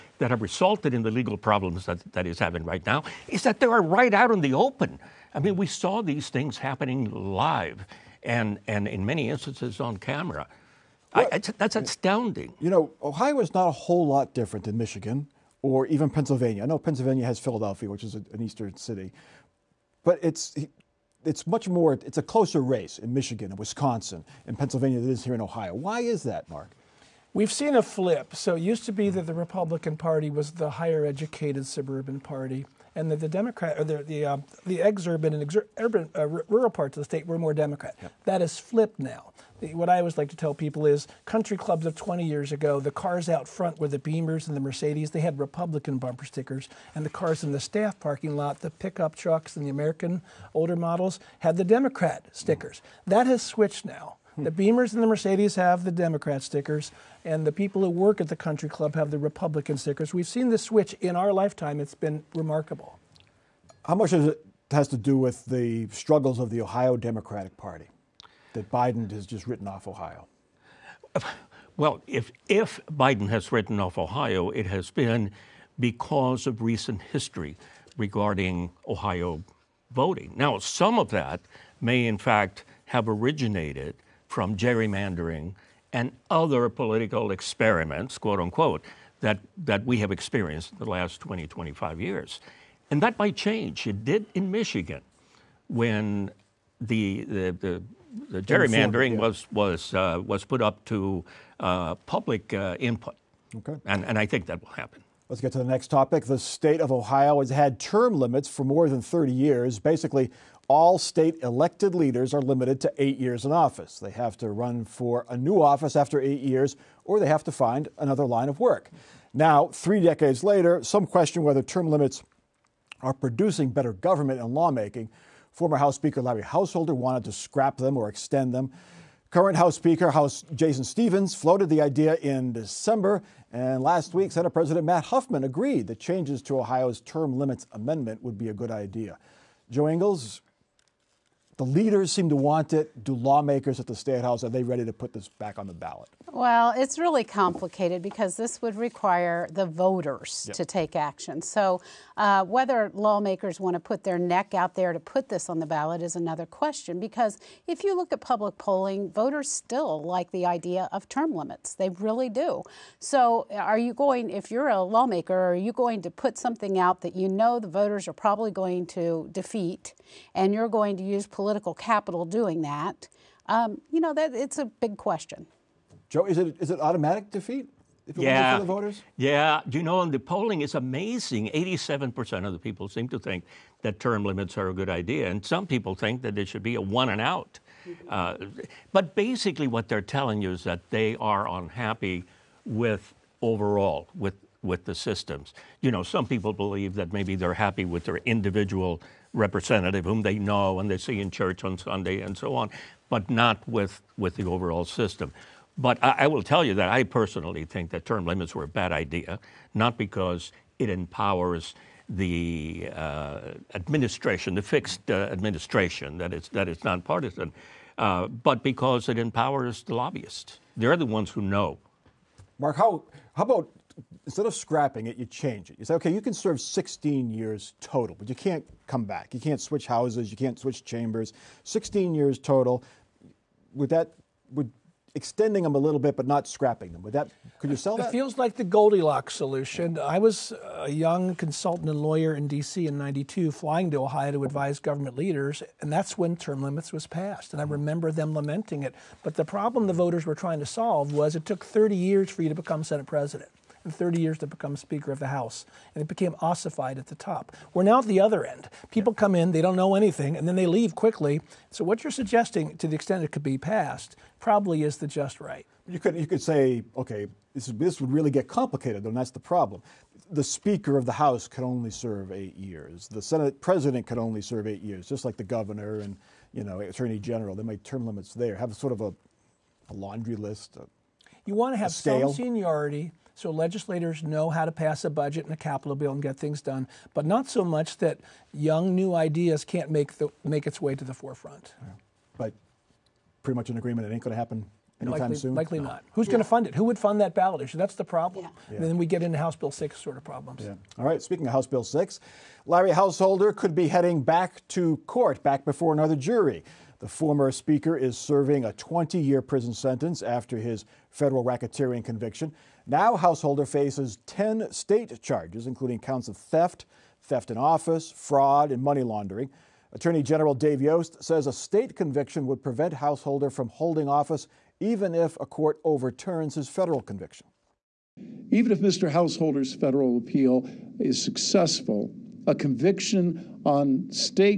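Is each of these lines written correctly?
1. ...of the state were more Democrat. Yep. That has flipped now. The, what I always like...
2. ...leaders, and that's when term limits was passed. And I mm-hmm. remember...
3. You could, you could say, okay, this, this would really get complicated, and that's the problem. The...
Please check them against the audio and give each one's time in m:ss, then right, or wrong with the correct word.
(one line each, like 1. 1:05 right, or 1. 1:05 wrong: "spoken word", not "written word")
1. 0:36 right
2. 4:05 right
3. 4:25 right.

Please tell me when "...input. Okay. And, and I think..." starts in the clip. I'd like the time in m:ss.
1:42.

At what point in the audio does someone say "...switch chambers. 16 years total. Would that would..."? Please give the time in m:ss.
3:50.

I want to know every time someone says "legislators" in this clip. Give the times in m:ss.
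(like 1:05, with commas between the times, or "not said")
4:43.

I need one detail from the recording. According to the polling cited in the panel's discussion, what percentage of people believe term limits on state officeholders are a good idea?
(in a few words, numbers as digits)
87%.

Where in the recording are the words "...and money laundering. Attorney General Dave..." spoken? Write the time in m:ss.
5:18.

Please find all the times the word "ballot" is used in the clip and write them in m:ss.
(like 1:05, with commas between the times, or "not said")
2:25, 2:35, 4:57.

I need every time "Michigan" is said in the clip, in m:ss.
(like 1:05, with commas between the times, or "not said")
0:14, 0:23, 1:34.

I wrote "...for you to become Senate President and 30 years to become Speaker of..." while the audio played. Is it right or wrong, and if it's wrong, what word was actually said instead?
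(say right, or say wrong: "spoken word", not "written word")
right.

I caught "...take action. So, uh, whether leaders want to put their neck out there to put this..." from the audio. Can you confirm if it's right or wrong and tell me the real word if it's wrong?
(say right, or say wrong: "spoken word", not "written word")
wrong: "lawmakers", not "leaders".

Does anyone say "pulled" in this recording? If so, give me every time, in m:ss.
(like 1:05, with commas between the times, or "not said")
not said.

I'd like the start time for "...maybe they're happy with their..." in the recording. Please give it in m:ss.
3:17.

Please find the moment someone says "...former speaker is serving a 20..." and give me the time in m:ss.
5:07.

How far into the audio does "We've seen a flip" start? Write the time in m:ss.
0:27.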